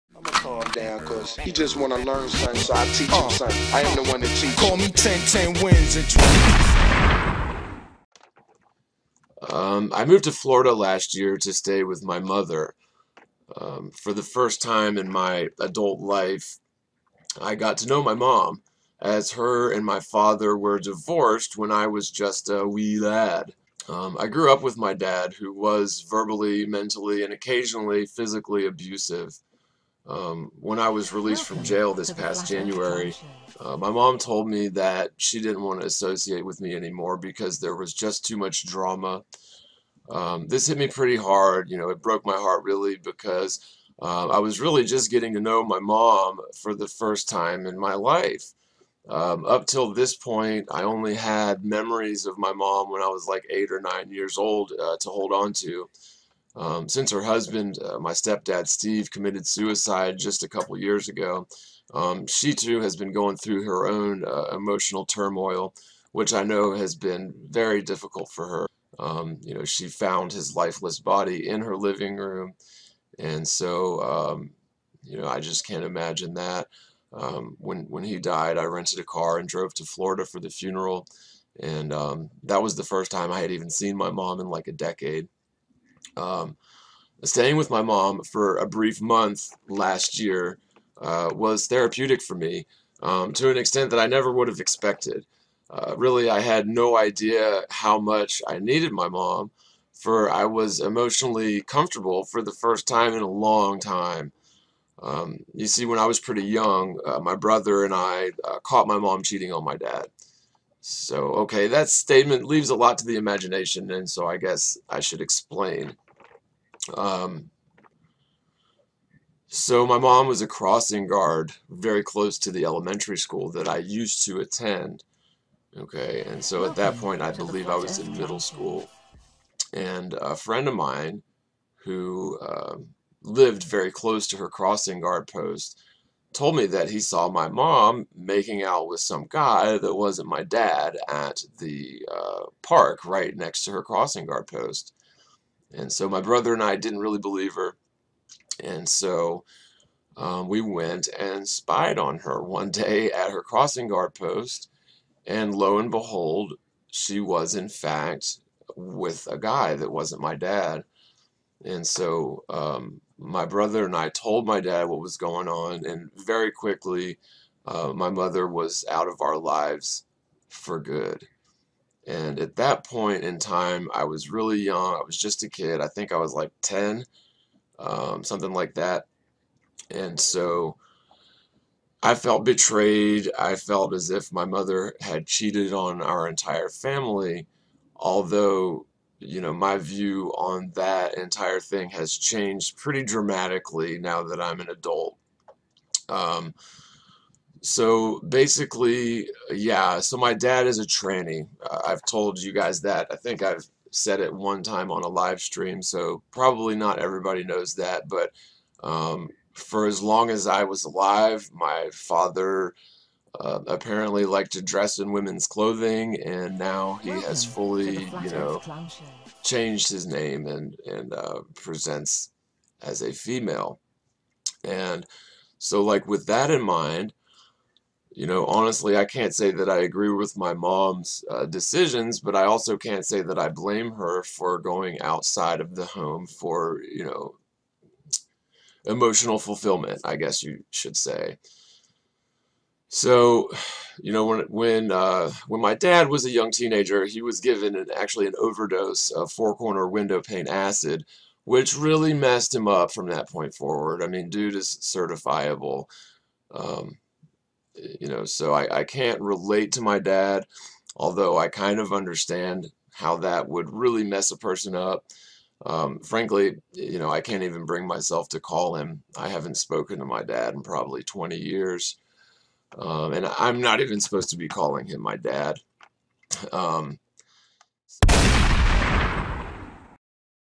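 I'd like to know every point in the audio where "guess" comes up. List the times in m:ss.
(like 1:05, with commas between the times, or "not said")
1:54, 4:00.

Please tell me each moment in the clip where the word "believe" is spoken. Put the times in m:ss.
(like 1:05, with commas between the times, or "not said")
2:07, 2:27.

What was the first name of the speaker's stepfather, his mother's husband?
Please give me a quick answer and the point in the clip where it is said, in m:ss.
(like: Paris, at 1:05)
Steve, at 0:58.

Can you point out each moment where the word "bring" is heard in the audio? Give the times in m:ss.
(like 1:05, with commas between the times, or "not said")
4:27.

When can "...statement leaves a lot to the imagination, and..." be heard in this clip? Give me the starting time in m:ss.
1:51.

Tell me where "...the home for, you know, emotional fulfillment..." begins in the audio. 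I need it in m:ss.
3:55.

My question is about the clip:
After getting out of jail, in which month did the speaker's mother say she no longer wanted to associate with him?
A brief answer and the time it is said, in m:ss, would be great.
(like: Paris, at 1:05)
January, at 0:32.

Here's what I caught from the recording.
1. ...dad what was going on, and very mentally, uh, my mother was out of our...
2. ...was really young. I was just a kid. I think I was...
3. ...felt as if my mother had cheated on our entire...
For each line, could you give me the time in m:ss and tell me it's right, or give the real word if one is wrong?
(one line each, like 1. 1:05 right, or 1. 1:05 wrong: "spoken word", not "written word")
1. 2:44 wrong: "quickly", not "mentally"
2. 2:54 right
3. 3:03 right.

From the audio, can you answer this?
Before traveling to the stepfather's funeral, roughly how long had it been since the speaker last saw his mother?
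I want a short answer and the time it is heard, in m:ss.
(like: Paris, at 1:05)
a decade, at 1:24.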